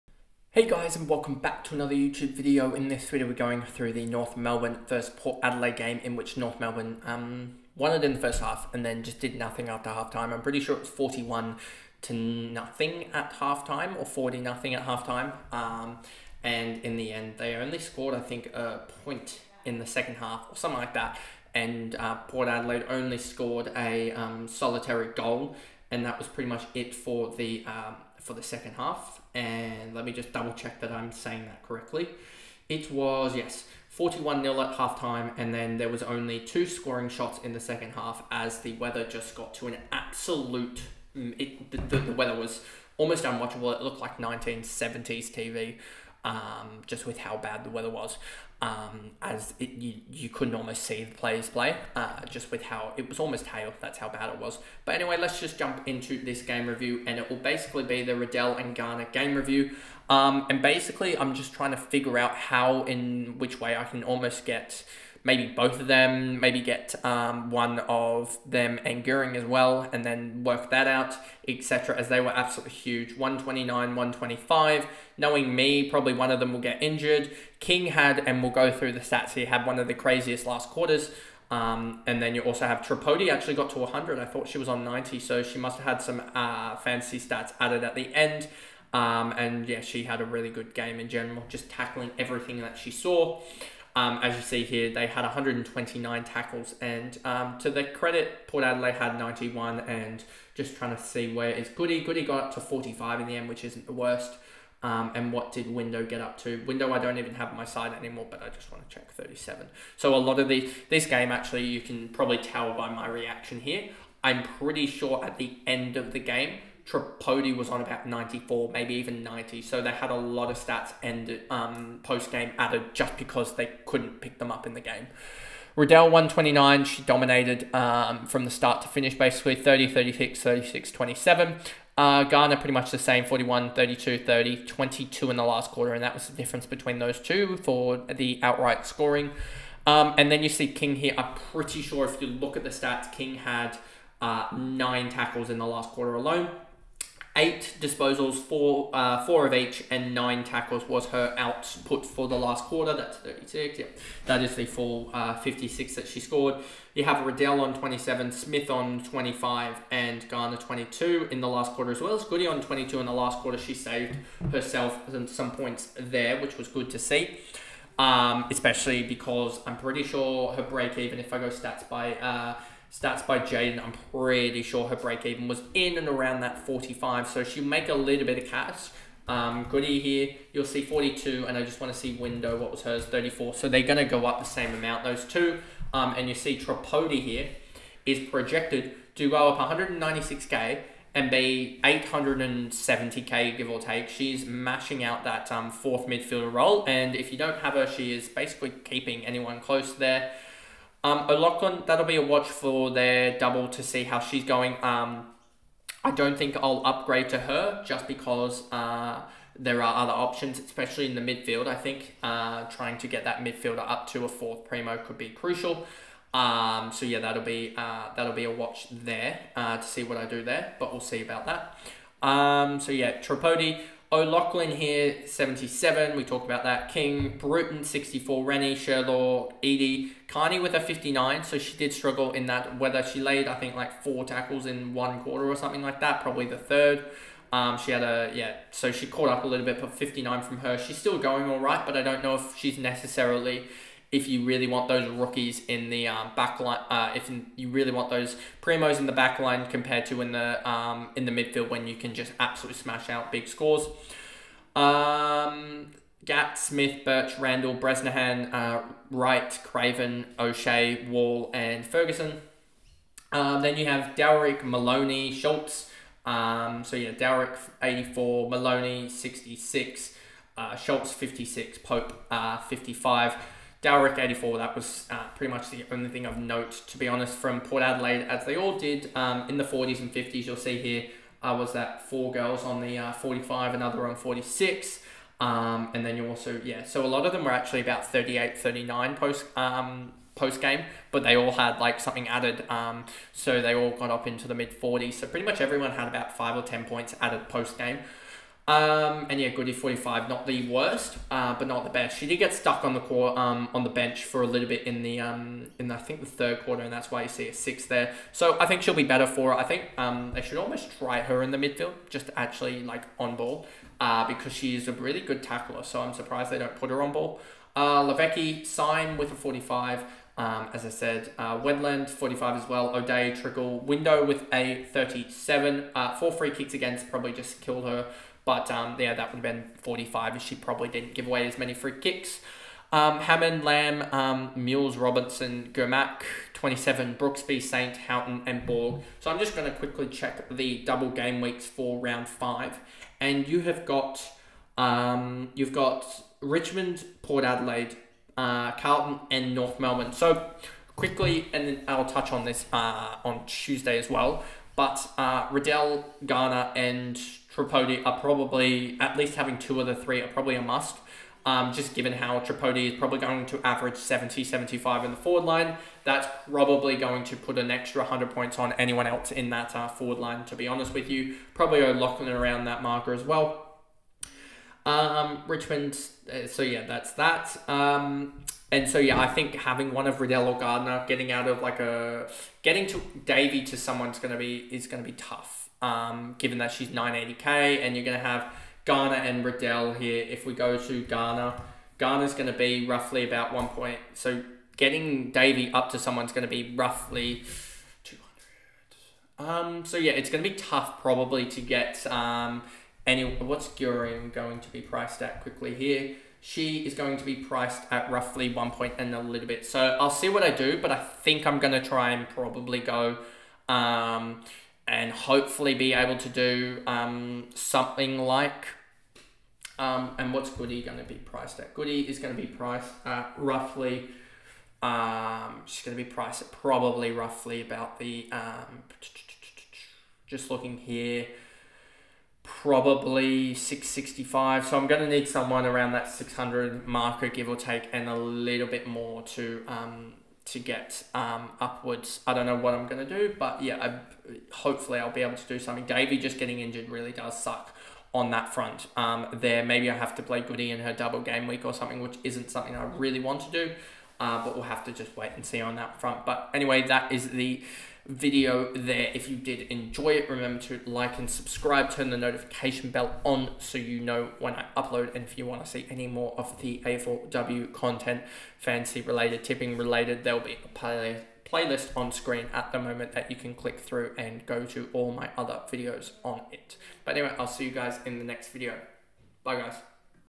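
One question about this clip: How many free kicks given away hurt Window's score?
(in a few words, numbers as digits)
4.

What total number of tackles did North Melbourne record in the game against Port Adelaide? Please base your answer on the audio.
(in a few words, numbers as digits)
129.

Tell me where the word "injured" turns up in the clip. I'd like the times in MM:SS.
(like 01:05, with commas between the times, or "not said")
01:16, 07:26.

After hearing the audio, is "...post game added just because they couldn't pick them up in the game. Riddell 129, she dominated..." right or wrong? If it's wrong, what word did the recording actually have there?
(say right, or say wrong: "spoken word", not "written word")
right.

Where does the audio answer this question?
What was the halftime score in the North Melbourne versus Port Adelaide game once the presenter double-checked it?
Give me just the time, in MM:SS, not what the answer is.
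00:33.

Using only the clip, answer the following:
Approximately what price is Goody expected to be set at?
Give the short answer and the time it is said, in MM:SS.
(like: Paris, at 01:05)
665, at 07:13.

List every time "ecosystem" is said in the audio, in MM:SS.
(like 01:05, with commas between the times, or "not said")
not said.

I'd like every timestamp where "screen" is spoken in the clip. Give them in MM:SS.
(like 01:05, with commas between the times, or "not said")
07:52.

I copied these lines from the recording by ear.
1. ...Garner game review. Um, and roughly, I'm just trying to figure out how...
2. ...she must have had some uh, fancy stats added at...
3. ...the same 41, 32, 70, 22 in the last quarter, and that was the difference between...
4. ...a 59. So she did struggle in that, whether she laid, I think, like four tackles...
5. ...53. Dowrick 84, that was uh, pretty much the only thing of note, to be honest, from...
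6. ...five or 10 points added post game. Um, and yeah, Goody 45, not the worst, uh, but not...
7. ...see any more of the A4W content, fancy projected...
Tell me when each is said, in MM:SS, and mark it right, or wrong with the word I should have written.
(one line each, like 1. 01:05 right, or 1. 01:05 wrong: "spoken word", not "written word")
1. 00:58 wrong: "basically", not "roughly"
2. 01:25 right
3. 02:12 wrong: "30", not "70"
4. 03:50 right
5. 04:32 wrong: "55", not "53"
6. 04:56 right
7. 07:45 wrong: "related", not "projected".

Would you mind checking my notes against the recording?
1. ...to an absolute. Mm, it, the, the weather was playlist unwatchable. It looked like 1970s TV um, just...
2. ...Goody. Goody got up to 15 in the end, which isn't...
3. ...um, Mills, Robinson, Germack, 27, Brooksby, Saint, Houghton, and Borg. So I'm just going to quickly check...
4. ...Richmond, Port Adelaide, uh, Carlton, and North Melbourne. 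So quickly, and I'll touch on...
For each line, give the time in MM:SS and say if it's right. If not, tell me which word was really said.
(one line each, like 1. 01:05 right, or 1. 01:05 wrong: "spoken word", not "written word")
1. 00:39 wrong: "almost", not "playlist"
2. 01:41 wrong: "45", not "15"
3. 05:34 right
4. 05:46 right.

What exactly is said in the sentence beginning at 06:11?
Probably locking around that marker as well.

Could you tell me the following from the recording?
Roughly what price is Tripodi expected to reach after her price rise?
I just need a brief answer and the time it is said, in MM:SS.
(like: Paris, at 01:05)
870k, at 03:11.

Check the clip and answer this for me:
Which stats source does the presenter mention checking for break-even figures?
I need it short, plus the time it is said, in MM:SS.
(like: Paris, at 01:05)
Stats by Jaden, at 02:52.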